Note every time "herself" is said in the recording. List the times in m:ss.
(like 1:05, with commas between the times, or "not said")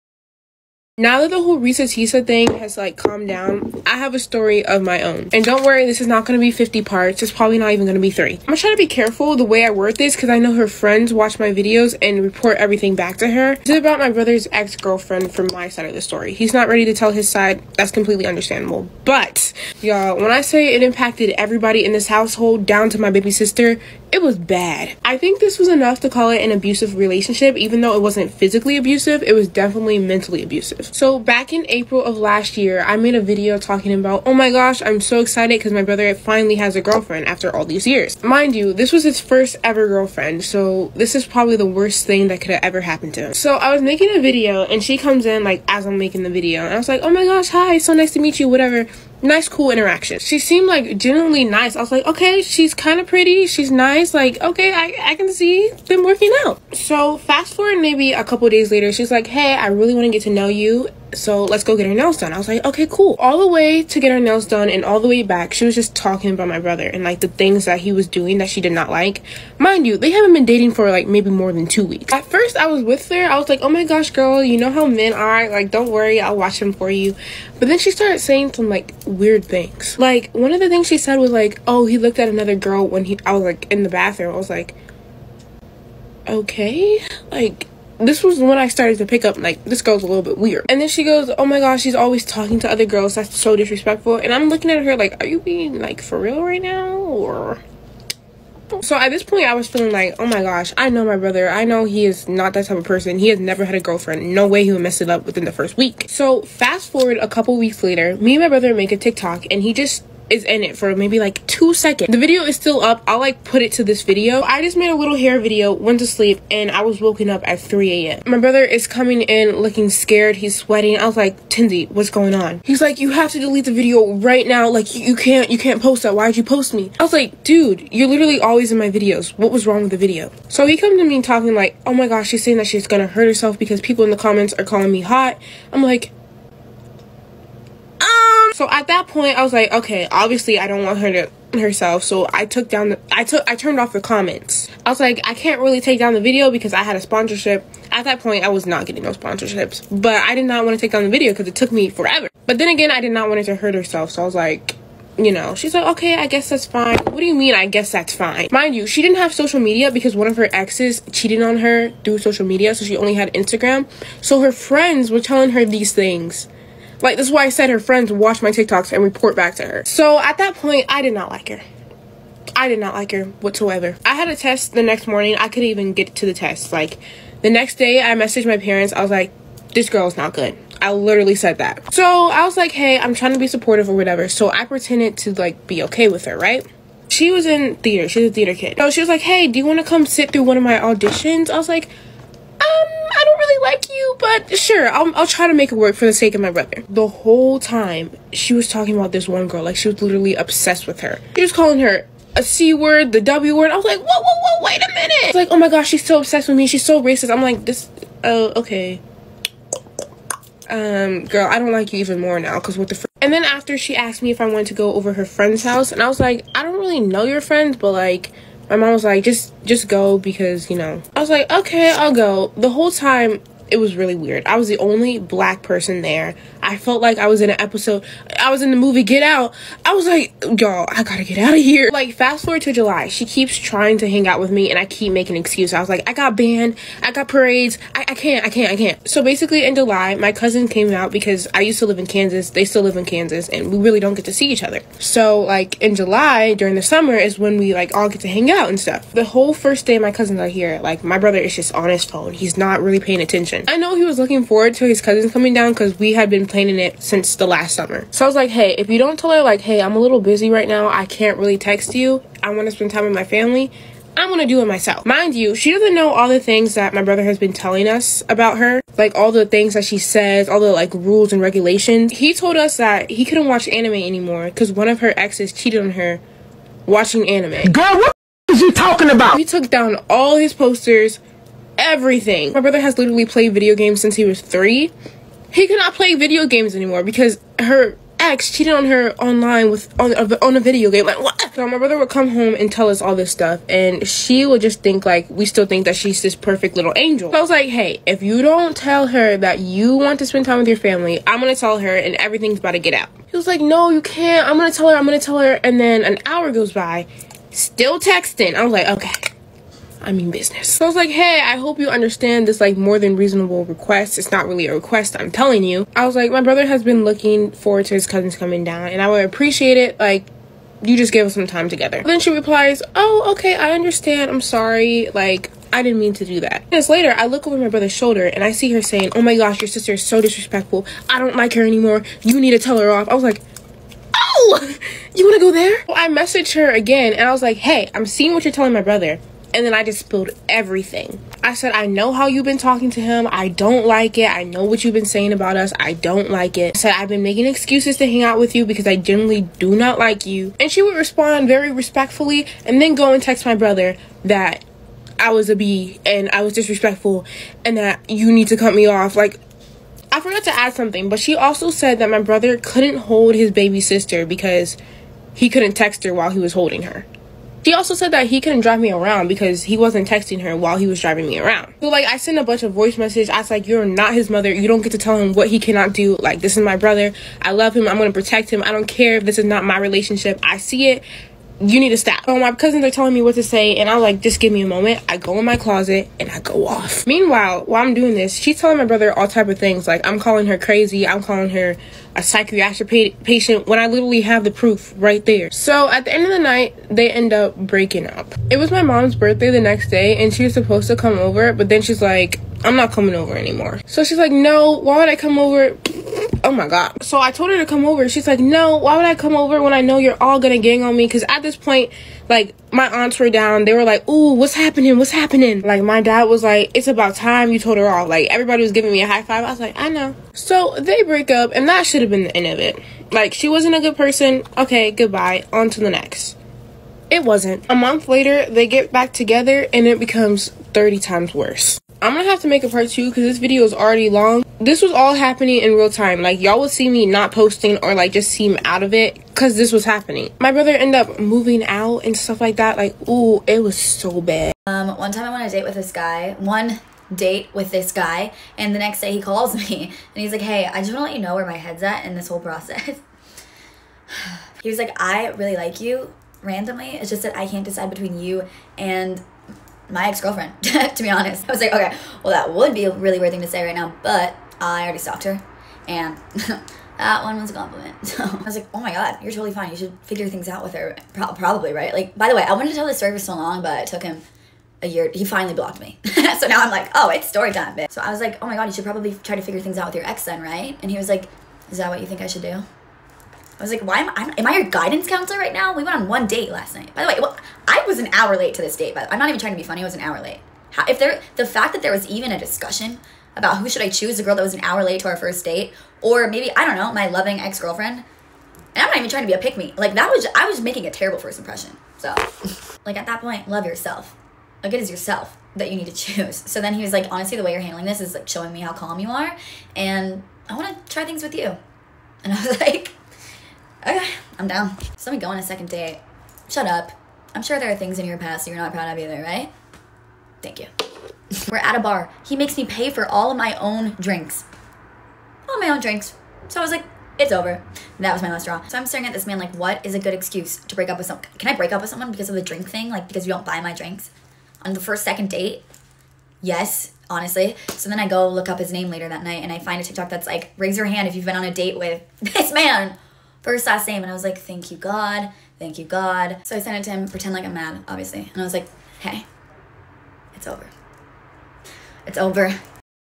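2:13, 2:21, 2:33.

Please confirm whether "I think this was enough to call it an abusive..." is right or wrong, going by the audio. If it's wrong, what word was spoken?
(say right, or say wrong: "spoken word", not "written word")
right.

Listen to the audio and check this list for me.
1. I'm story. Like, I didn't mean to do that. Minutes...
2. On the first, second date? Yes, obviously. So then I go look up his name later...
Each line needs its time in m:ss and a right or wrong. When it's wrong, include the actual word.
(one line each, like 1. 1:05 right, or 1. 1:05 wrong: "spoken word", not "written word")
1. 5:24 wrong: "sorry", not "story"
2. 8:54 wrong: "honestly", not "obviously".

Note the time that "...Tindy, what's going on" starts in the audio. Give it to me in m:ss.
2:01.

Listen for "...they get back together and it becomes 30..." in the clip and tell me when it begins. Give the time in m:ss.
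7:08.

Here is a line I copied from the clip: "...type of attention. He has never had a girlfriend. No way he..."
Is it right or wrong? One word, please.
wrong.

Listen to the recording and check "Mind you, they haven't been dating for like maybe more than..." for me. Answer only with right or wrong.
right.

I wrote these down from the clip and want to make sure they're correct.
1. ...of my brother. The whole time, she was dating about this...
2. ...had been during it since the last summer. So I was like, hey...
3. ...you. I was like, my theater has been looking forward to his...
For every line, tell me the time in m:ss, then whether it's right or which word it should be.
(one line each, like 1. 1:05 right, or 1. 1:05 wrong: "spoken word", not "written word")
1. 3:16 wrong: "talking", not "dating"
2. 4:16 wrong: "planning", not "during"
3. 5:15 wrong: "brother", not "theater".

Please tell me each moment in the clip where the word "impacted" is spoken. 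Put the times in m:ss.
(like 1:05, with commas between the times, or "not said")
0:20.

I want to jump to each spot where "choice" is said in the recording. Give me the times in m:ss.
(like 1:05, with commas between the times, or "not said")
not said.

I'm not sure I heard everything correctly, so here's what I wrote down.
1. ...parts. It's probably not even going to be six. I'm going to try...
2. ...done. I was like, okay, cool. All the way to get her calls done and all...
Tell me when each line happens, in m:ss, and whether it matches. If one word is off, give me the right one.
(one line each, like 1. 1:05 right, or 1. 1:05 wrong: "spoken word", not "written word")
1. 0:06 wrong: "three", not "six"
2. 1:02 wrong: "nails", not "calls".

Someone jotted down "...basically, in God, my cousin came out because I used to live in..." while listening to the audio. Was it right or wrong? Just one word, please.
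wrong.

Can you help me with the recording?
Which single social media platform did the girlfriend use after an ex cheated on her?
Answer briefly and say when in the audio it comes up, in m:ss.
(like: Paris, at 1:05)
Instagram, at 2:43.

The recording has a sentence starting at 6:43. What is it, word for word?
So she's like, no, why would I come over?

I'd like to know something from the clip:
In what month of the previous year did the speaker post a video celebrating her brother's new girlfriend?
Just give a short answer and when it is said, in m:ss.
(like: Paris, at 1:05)
April, at 0:31.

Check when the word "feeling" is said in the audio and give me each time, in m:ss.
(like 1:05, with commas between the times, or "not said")
1:39.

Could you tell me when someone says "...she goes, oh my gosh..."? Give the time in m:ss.
1:30.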